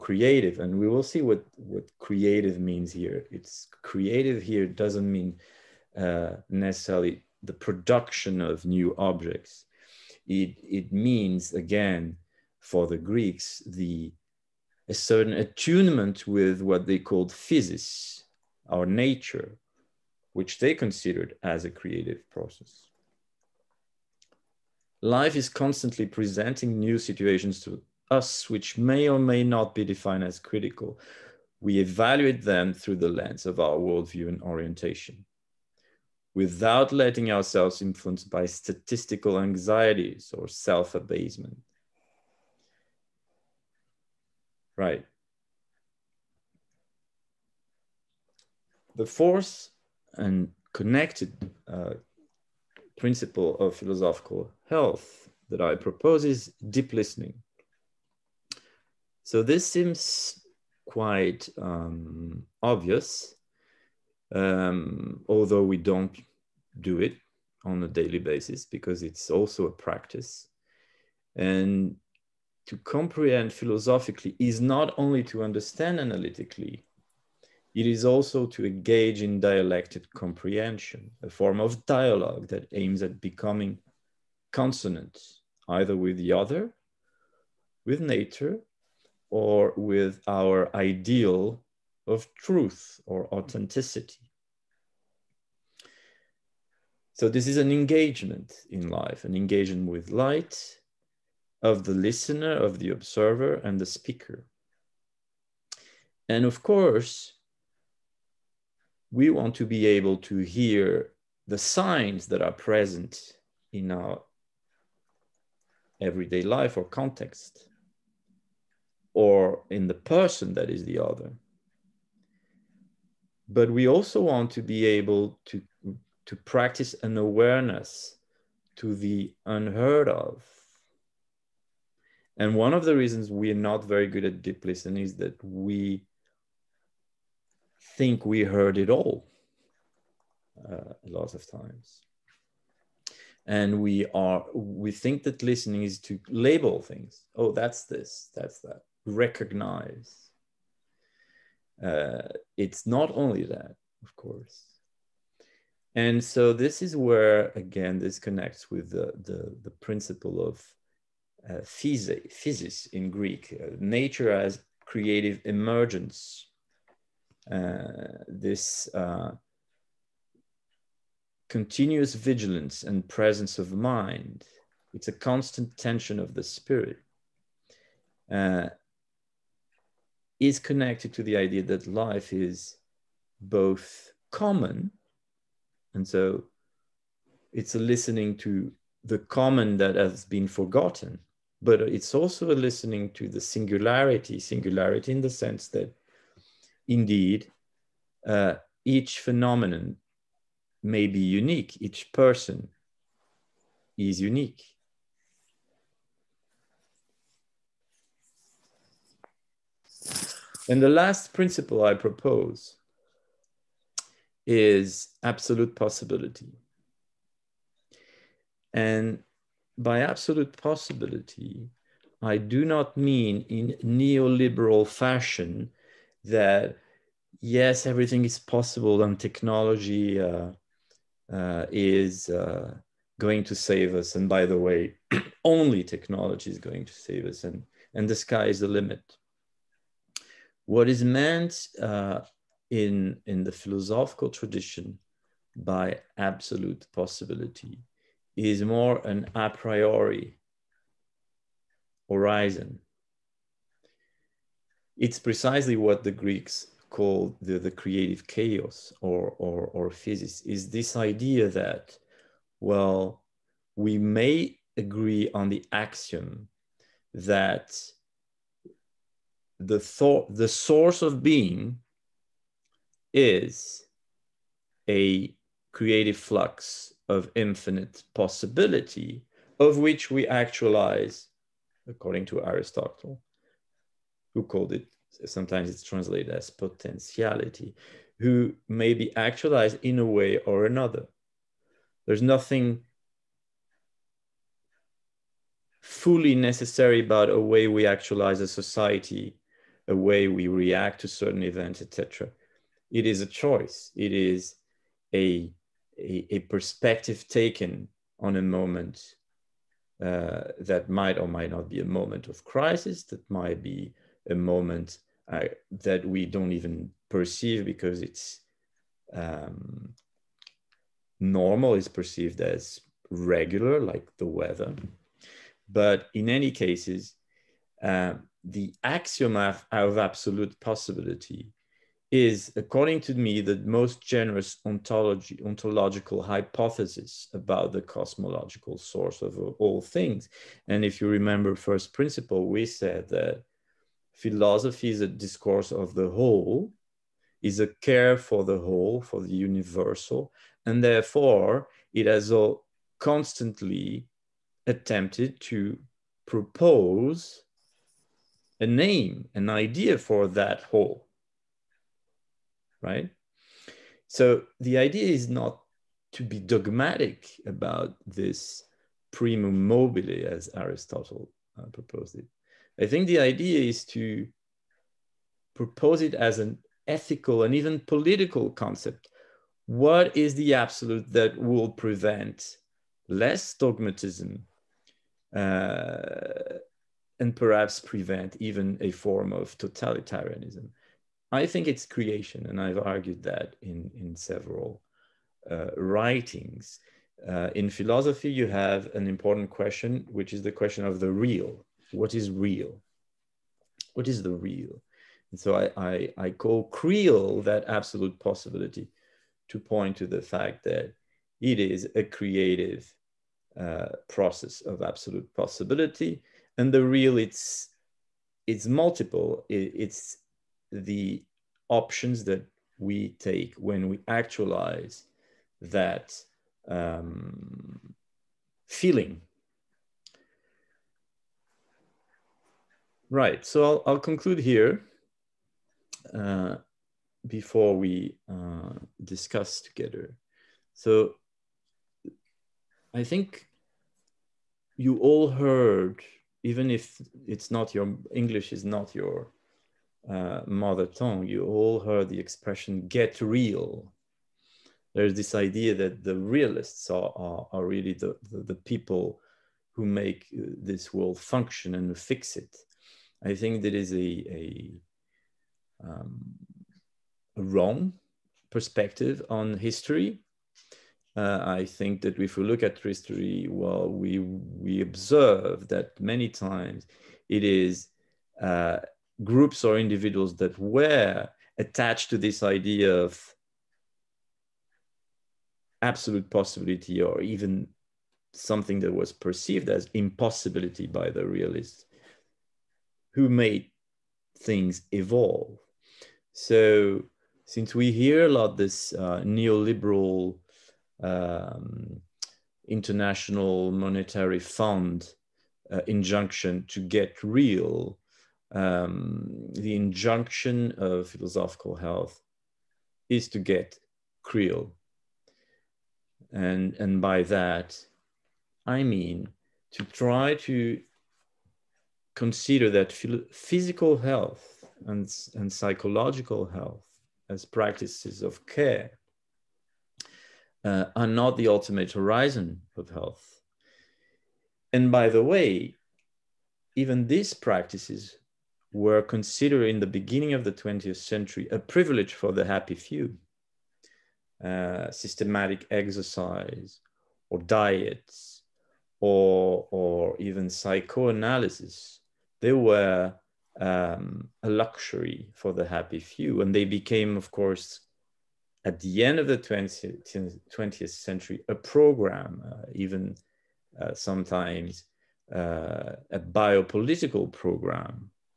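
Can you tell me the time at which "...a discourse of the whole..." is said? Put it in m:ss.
5:45.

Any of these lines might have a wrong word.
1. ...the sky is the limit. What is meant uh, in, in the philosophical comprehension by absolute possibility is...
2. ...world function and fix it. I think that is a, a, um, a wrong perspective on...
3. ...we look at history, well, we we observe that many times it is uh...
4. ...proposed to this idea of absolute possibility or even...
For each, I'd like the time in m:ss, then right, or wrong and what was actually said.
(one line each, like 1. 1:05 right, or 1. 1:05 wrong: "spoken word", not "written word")
1. 3:58 wrong: "tradition", not "comprehension"
2. 7:40 right
3. 7:52 right
4. 8:01 wrong: "attached", not "proposed".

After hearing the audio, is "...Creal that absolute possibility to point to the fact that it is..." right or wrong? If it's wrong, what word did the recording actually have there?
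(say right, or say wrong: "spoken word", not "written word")
right.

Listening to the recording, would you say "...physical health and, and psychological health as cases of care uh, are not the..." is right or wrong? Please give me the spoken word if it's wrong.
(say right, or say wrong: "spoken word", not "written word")
wrong: "practices", not "cases".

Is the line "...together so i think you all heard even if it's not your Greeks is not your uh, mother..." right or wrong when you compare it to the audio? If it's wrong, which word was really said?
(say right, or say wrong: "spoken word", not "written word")
wrong: "English", not "Greeks".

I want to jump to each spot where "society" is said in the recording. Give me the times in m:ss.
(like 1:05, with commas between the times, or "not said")
4:58.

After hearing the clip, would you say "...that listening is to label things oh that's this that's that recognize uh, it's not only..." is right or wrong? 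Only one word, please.
right.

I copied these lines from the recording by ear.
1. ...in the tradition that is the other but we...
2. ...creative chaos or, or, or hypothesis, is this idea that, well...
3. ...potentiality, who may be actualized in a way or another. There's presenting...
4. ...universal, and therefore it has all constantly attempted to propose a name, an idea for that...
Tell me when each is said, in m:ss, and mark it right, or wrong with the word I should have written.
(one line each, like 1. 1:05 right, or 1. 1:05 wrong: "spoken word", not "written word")
1. 1:59 wrong: "person", not "tradition"
2. 4:17 wrong: "physis", not "hypothesis"
3. 4:46 wrong: "nothing", not "presenting"
4. 5:49 right.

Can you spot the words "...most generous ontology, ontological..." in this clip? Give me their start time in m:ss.
5:33.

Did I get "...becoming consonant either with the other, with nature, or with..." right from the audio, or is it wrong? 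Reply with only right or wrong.
right.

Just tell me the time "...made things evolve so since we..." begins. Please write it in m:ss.
8:13.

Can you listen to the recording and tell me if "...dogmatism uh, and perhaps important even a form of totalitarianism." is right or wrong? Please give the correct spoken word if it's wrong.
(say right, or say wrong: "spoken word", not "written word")
wrong: "prevent", not "important".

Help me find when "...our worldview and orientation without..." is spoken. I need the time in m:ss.
0:33.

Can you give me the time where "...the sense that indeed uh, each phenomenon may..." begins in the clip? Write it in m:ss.
3:15.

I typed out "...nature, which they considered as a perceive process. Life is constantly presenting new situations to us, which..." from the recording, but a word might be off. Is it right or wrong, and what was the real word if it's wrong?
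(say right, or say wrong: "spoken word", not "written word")
wrong: "creative", not "perceive".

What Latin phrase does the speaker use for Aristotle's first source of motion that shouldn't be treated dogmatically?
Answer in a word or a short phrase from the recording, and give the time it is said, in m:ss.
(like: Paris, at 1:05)
primum mobile, at 6:09.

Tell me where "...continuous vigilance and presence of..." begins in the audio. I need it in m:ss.
2:51.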